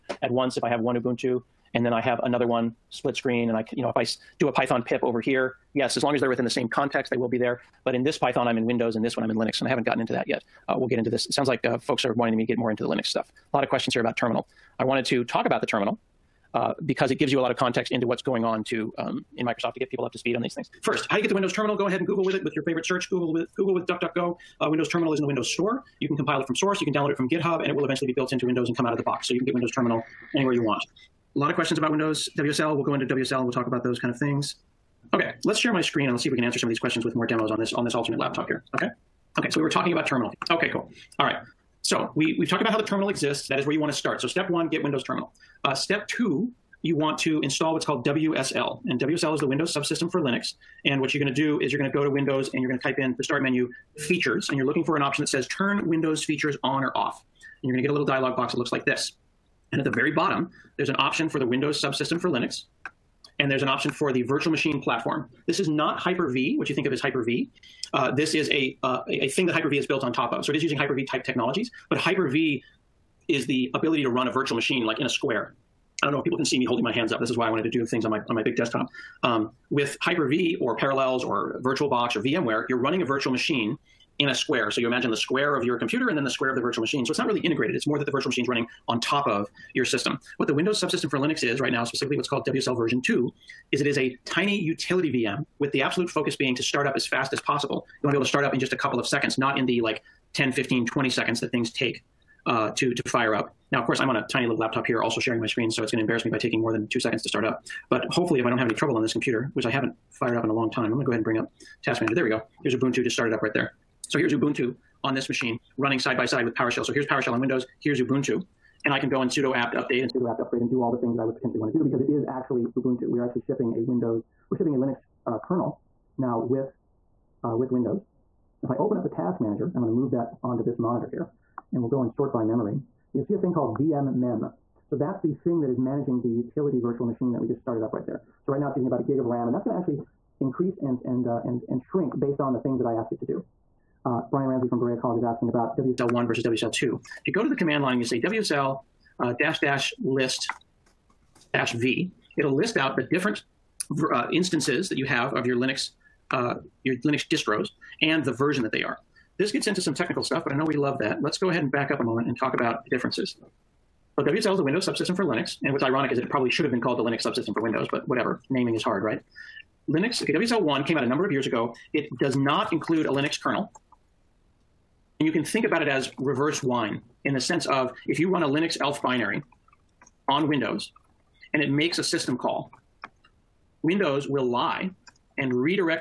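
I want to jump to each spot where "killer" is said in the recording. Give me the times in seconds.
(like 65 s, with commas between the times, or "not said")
not said.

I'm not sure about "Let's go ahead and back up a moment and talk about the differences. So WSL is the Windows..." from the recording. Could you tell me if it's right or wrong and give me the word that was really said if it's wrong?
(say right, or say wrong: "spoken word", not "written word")
right.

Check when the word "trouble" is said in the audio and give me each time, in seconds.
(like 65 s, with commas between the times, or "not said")
108 s.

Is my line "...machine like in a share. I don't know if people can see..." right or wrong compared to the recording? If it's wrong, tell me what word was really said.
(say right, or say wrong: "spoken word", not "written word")
wrong: "square", not "share".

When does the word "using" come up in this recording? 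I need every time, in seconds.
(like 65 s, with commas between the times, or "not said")
70 s, 138 s.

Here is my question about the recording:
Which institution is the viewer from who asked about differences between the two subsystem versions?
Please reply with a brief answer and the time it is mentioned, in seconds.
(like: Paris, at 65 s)
Berea College, at 144 s.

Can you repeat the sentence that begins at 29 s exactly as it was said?
So you can get Windows Terminal anywhere you want.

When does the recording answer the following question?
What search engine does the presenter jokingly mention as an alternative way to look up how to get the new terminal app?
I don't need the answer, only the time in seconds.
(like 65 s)
23 s.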